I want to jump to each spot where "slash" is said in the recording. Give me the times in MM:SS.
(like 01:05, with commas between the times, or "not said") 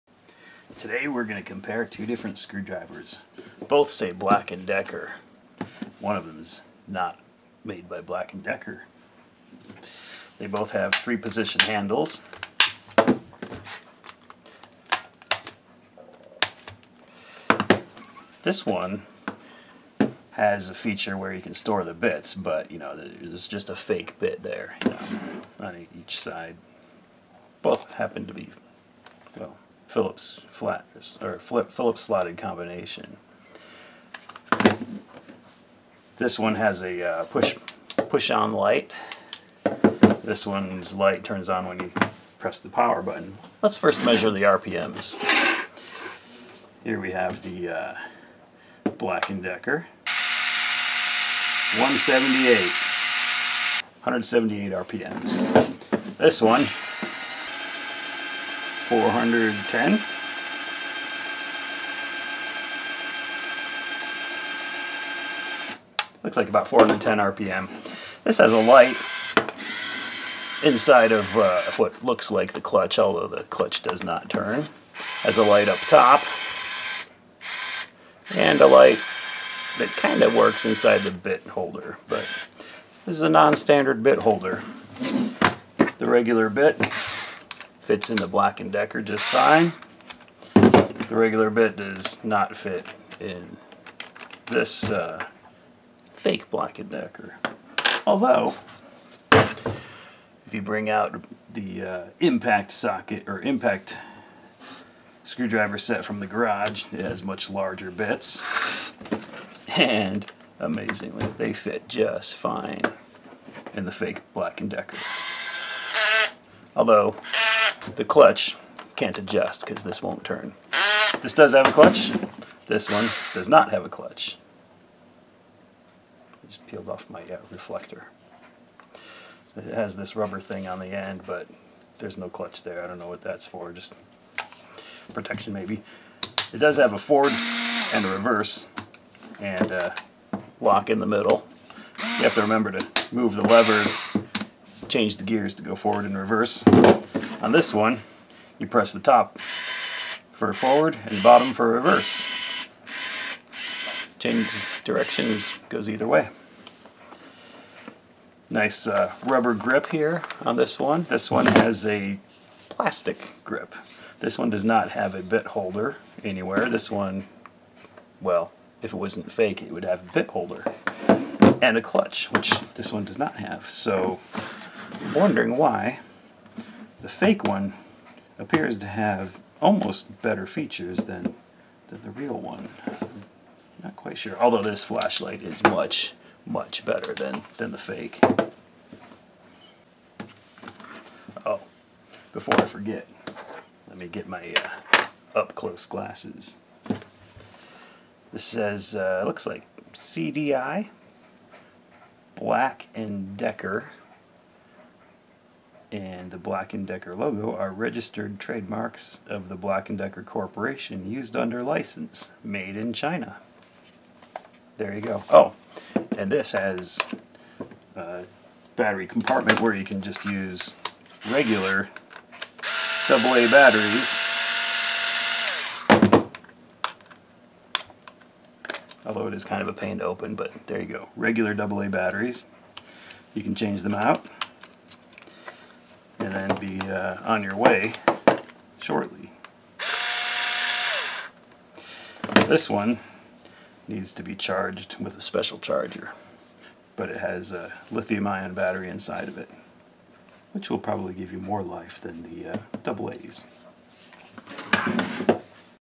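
not said.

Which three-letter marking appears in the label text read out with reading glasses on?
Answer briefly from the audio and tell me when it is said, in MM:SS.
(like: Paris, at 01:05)
CDI, at 03:19.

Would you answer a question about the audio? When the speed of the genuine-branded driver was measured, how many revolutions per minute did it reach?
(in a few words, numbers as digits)
178.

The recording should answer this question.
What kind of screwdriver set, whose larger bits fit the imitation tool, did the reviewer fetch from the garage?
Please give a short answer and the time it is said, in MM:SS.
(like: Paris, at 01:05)
impact screwdriver set, at 01:43.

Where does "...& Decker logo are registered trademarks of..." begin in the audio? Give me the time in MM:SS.
03:26.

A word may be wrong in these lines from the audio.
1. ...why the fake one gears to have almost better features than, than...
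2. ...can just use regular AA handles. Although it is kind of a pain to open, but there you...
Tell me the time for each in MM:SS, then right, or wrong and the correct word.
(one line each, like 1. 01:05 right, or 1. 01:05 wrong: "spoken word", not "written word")
1. 02:55 wrong: "appears", not "gears"
2. 03:39 wrong: "batteries", not "handles".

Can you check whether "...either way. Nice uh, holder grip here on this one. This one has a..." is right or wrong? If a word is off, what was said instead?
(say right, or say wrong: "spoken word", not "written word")
wrong: "rubber", not "holder".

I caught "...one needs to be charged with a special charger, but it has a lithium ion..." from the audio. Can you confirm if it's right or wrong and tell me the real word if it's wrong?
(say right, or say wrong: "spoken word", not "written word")
right.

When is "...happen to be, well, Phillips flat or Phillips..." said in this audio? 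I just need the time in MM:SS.
00:27.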